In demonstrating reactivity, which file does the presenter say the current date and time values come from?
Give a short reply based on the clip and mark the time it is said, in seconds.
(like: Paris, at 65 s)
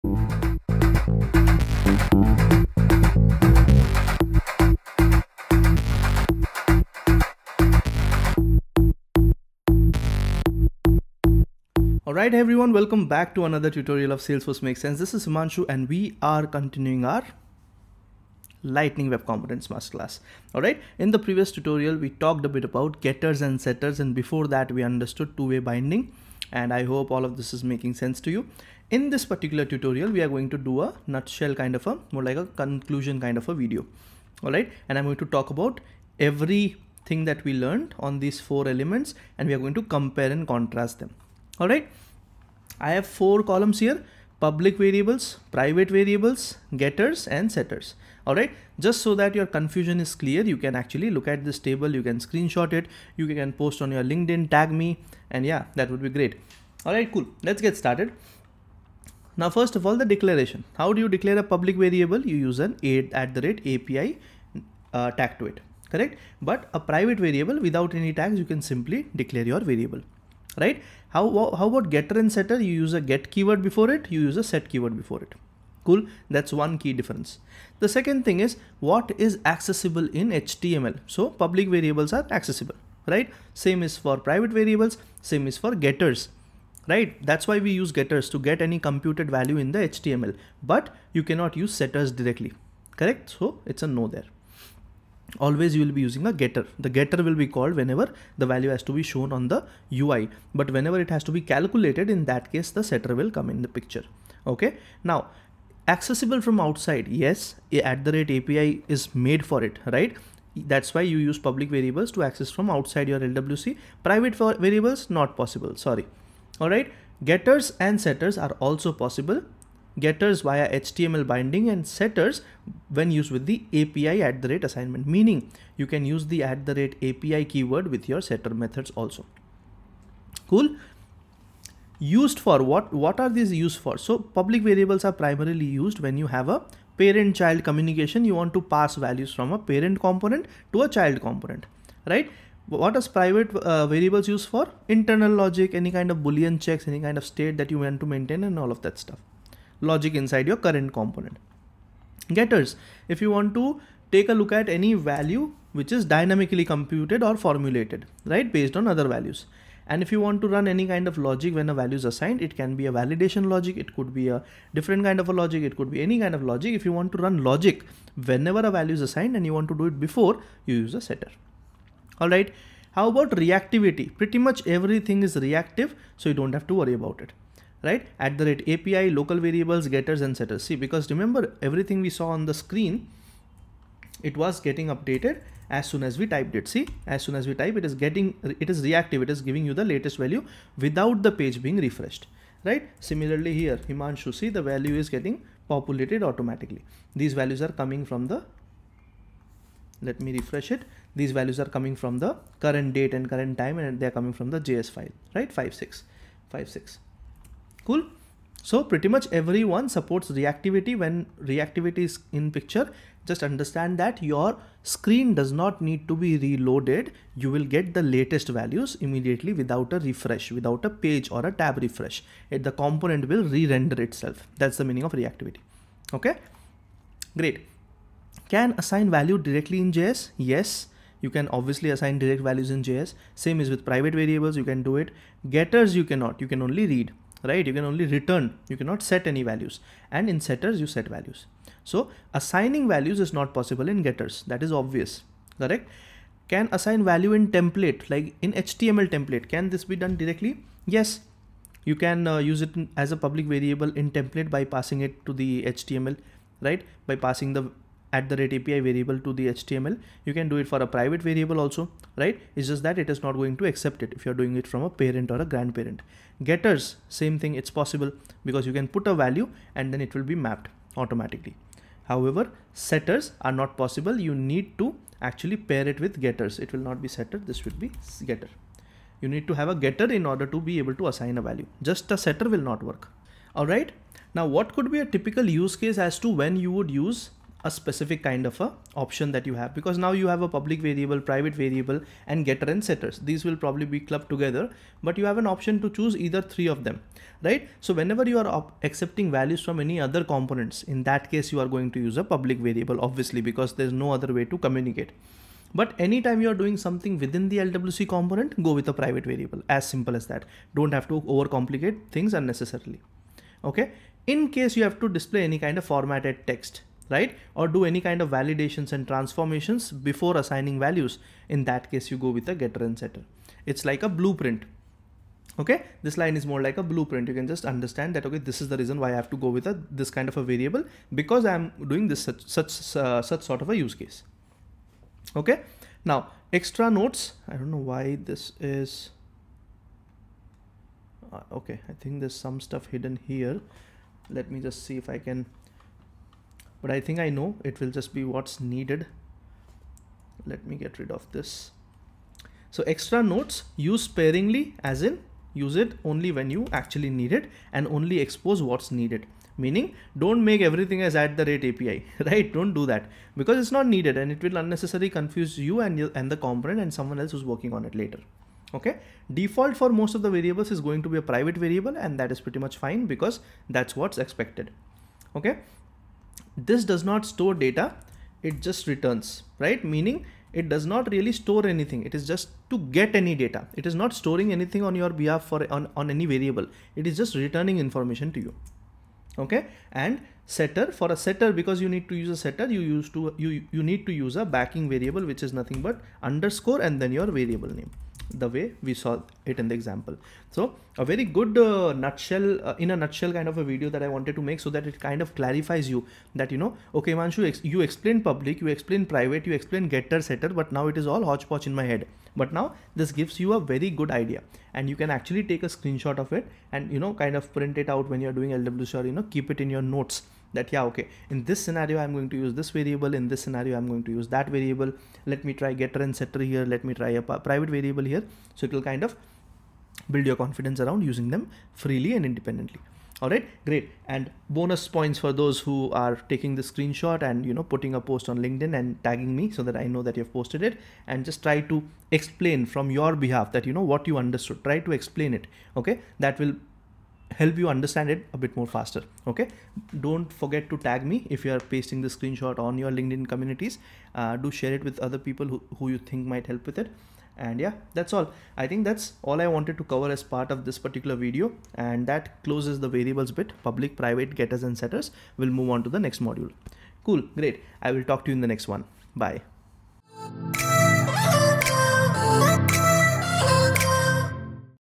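JS file, at 204 s.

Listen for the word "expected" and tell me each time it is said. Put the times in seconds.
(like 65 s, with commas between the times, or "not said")
374 s.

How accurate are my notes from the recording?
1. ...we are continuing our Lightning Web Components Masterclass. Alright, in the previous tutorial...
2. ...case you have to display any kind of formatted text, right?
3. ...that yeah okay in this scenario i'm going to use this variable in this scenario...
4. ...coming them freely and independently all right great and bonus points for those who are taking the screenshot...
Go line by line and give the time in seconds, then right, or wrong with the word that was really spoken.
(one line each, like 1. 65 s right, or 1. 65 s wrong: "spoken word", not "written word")
1. 15 s right
2. 314 s right
3. 420 s right
4. 431 s wrong: "using", not "coming".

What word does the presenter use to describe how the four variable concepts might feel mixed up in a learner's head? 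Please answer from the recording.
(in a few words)
hodgepodge.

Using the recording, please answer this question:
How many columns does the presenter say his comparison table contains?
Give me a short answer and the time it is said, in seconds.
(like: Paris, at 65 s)
4, at 43 s.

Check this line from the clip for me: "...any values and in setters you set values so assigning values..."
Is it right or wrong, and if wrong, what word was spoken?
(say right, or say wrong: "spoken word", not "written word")
right.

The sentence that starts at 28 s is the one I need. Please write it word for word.
In this particular tutorial we are going to do a nutshell kind of a, more like a conclusion kind of a video.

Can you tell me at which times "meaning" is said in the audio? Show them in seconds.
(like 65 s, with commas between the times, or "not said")
125 s, 224 s, 359 s, 379 s.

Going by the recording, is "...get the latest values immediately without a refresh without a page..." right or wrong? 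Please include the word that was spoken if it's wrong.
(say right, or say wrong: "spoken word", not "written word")
right.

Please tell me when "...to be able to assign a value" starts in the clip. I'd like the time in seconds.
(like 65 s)
280 s.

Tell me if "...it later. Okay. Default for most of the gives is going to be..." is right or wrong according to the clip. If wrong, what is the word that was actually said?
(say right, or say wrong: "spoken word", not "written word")
wrong: "variables", not "gives".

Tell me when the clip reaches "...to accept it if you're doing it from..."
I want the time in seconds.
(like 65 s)
263 s.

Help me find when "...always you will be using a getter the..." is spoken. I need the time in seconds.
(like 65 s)
95 s.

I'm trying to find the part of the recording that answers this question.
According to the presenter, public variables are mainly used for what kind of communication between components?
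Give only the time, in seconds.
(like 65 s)
136 s.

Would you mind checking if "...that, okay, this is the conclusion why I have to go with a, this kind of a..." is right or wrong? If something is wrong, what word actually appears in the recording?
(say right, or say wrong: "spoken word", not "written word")
wrong: "reason", not "conclusion".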